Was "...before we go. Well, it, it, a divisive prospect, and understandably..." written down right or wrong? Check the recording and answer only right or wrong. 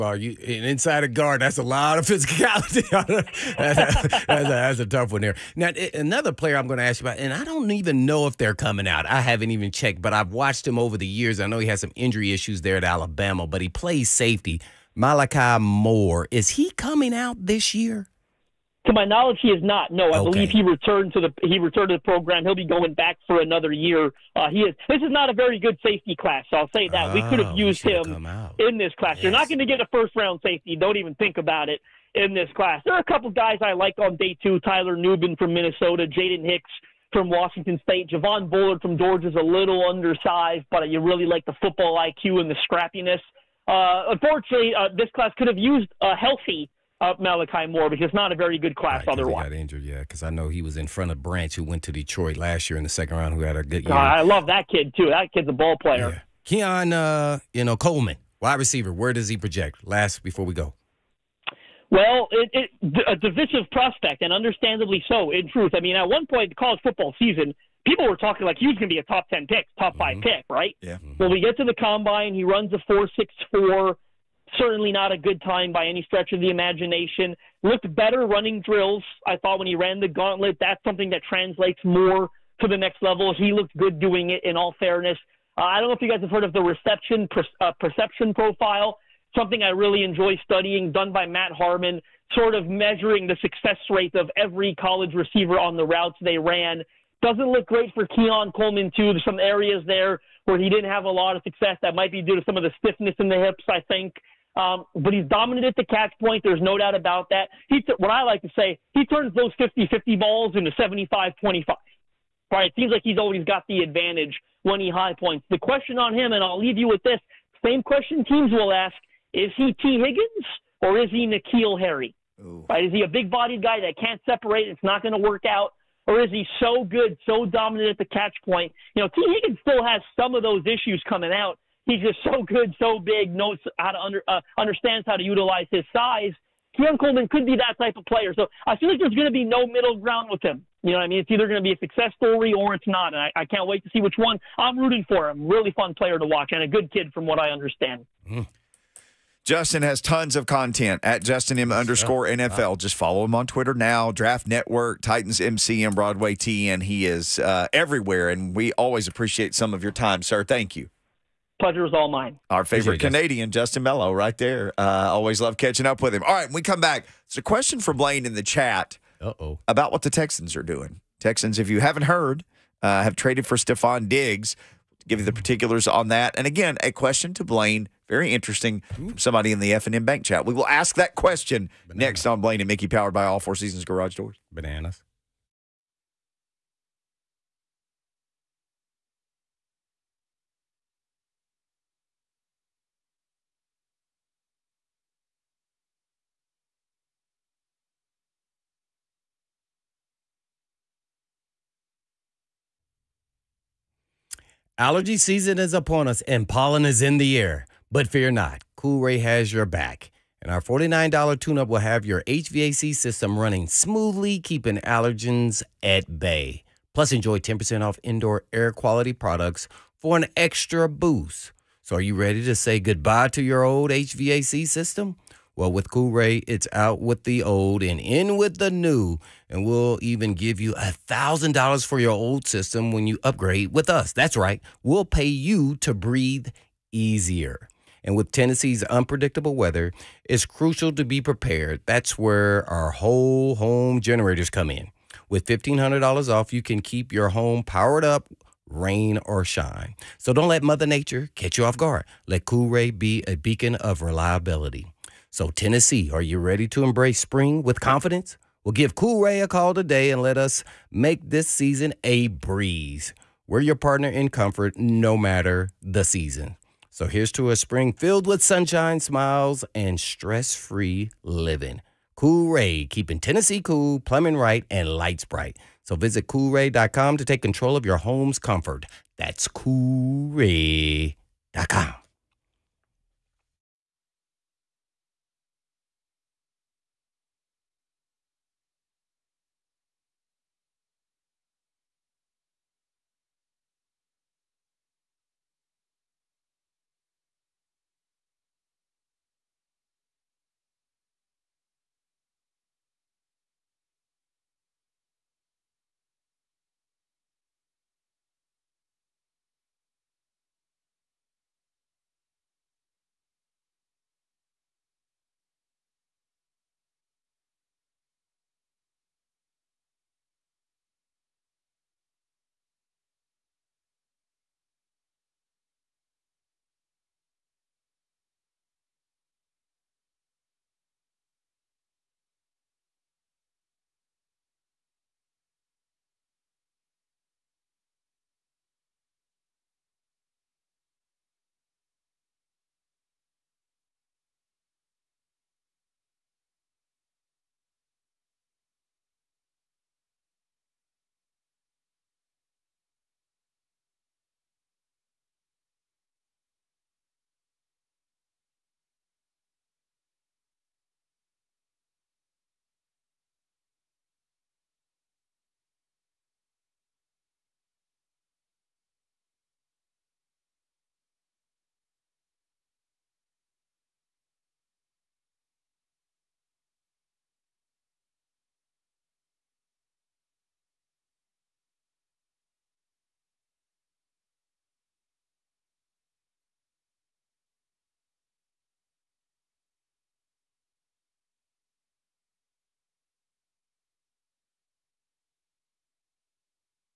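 right.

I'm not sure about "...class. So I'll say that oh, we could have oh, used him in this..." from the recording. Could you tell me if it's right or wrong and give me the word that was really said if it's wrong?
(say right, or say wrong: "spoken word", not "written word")
right.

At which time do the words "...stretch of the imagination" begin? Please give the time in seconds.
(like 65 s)
76 s.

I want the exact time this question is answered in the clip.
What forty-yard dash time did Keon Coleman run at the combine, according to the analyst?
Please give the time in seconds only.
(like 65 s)
72 s.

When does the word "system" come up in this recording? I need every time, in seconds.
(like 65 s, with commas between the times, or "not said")
212 s, 224 s, 232 s.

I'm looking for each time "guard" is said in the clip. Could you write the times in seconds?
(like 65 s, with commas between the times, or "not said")
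1 s, 251 s.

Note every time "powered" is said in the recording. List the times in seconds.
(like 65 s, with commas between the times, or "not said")
182 s, 247 s.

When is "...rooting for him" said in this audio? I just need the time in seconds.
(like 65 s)
144 s.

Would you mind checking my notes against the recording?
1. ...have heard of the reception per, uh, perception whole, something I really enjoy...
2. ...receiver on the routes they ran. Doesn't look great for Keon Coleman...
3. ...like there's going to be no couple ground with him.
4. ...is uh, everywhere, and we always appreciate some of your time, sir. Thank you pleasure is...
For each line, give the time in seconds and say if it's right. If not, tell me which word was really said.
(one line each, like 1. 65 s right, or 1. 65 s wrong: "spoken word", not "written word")
1. 86 s wrong: "profile", not "whole"
2. 95 s right
3. 138 s wrong: "middle", not "couple"
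4. 157 s right.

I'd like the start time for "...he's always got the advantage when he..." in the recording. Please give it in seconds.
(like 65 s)
113 s.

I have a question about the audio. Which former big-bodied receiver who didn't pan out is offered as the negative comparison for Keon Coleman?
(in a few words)
N'Keal Harry.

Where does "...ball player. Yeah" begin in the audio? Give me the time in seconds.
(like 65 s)
55 s.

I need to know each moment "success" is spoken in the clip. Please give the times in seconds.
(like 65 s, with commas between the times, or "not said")
93 s, 101 s, 141 s.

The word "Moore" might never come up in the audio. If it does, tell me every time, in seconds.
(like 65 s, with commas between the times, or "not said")
15 s, 47 s.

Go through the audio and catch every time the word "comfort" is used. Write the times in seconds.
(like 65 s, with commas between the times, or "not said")
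264 s, 278 s.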